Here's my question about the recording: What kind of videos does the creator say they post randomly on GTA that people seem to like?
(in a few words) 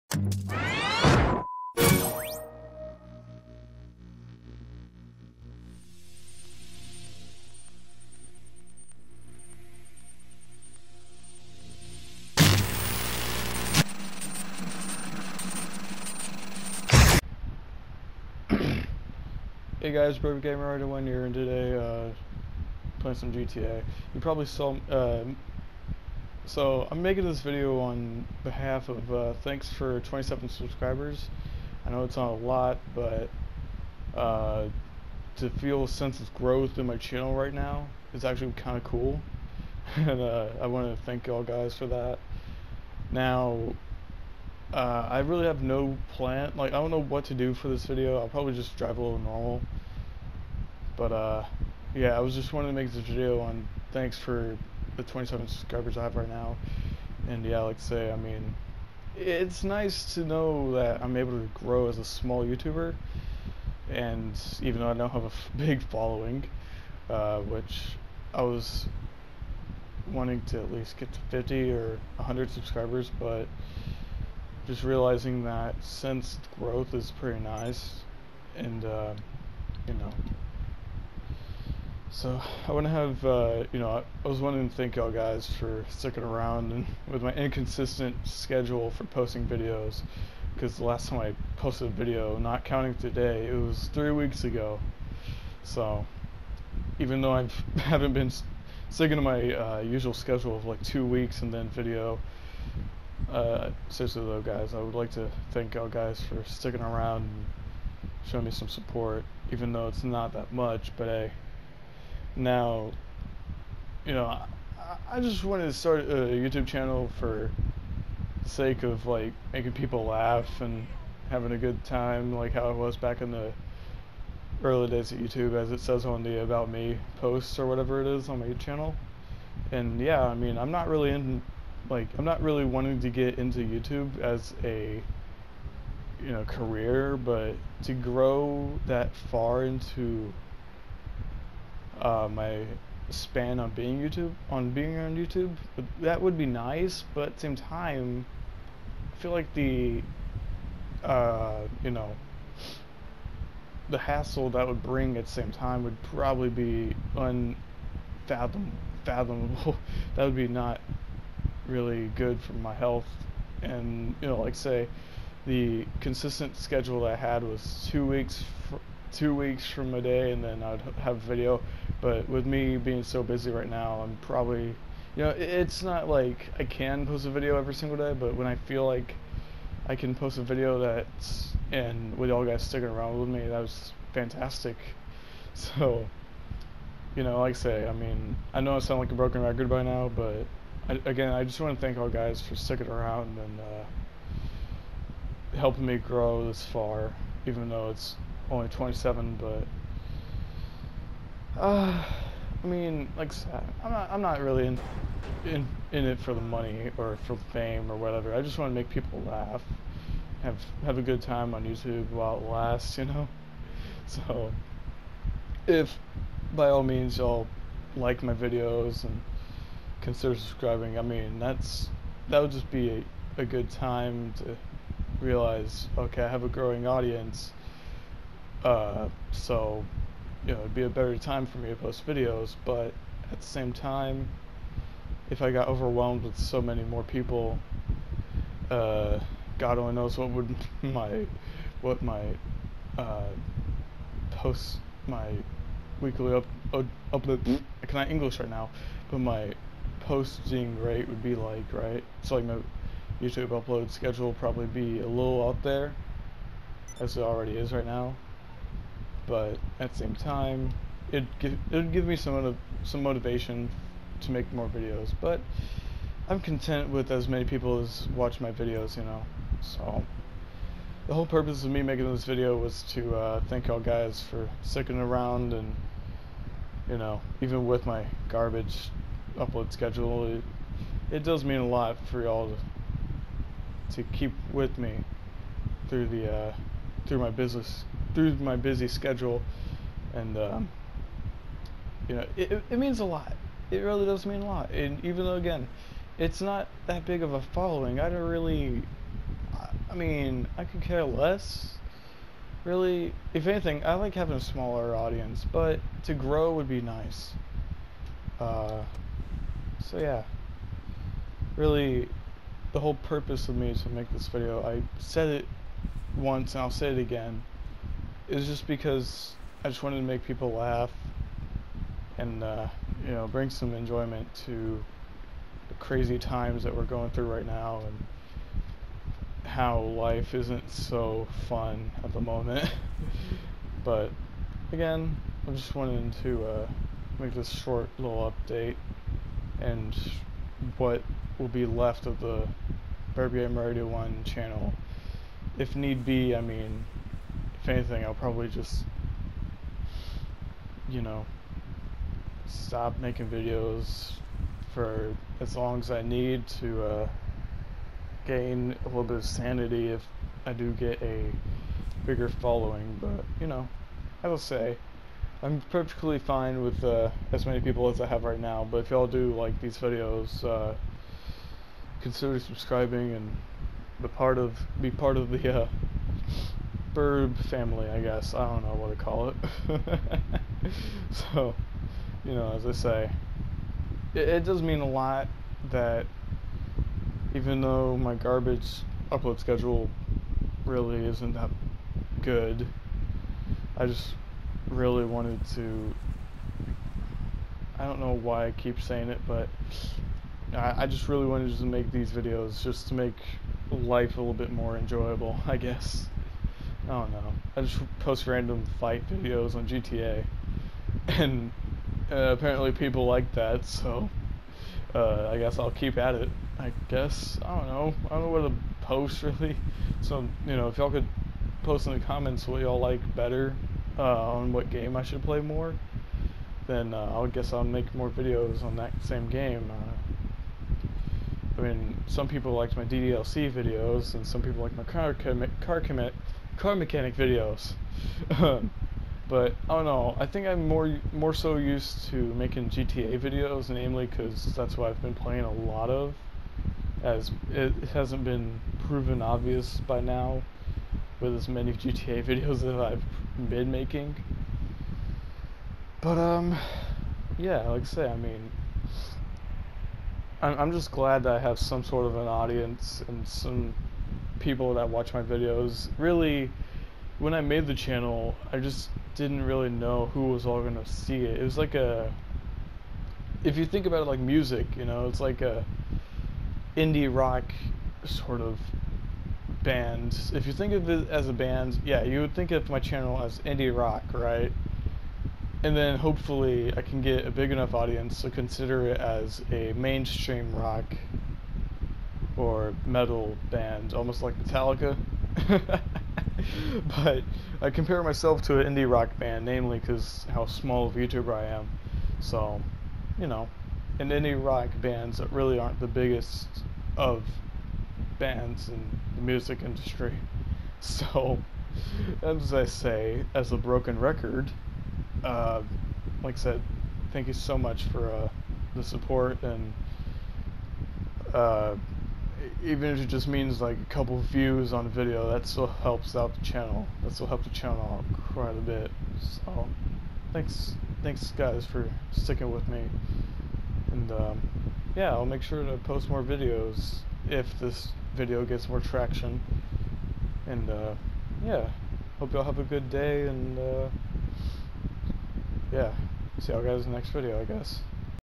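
fight videos.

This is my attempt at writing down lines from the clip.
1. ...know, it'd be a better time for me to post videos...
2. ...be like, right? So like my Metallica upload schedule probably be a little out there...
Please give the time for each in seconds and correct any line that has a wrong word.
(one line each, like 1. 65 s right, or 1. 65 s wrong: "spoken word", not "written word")
1. 230 s right
2. 251 s wrong: "YouTube", not "Metallica".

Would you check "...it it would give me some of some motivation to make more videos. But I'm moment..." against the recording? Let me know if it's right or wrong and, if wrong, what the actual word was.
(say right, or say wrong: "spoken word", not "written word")
wrong: "content", not "moment".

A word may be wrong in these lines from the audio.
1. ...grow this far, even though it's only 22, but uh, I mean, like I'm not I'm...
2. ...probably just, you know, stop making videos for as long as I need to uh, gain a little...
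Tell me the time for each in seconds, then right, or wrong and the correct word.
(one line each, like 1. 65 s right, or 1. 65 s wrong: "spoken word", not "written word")
1. 195 s wrong: "27", not "22"
2. 348 s right.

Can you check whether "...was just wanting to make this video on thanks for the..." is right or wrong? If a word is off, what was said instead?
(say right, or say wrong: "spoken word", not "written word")
right.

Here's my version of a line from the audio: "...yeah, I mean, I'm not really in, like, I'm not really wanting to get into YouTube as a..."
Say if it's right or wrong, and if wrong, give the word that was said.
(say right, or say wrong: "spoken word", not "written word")
right.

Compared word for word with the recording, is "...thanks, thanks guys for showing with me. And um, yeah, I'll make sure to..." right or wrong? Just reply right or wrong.
wrong.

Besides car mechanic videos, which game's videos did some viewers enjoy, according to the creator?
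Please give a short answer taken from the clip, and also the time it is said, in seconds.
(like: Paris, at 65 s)
DDLC, at 432 s.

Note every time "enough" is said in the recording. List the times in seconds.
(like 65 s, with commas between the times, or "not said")
487 s.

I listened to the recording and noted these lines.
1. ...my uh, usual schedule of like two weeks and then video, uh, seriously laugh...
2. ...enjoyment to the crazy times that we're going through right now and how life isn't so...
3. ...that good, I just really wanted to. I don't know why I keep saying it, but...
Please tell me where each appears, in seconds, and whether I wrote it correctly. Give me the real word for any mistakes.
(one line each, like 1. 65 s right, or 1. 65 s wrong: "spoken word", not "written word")
1. 99 s wrong: "though", not "laugh"
2. 323 s right
3. 391 s right.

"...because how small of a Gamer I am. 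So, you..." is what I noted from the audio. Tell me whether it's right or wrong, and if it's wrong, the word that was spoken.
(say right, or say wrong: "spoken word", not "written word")
wrong: "YouTuber", not "Gamer".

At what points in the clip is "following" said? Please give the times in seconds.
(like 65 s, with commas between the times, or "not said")
65 s, 297 s, 362 s.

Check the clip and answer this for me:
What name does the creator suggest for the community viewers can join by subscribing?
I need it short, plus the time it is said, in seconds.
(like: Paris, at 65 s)
Birb family, at 376 s.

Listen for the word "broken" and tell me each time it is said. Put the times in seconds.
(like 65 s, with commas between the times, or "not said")
189 s, 513 s.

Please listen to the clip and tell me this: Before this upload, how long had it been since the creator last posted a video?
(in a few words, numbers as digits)
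three weeks.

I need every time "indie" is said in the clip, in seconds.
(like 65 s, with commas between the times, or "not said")
476 s, 483 s, 498 s, 504 s.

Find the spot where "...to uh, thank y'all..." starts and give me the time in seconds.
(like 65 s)
272 s.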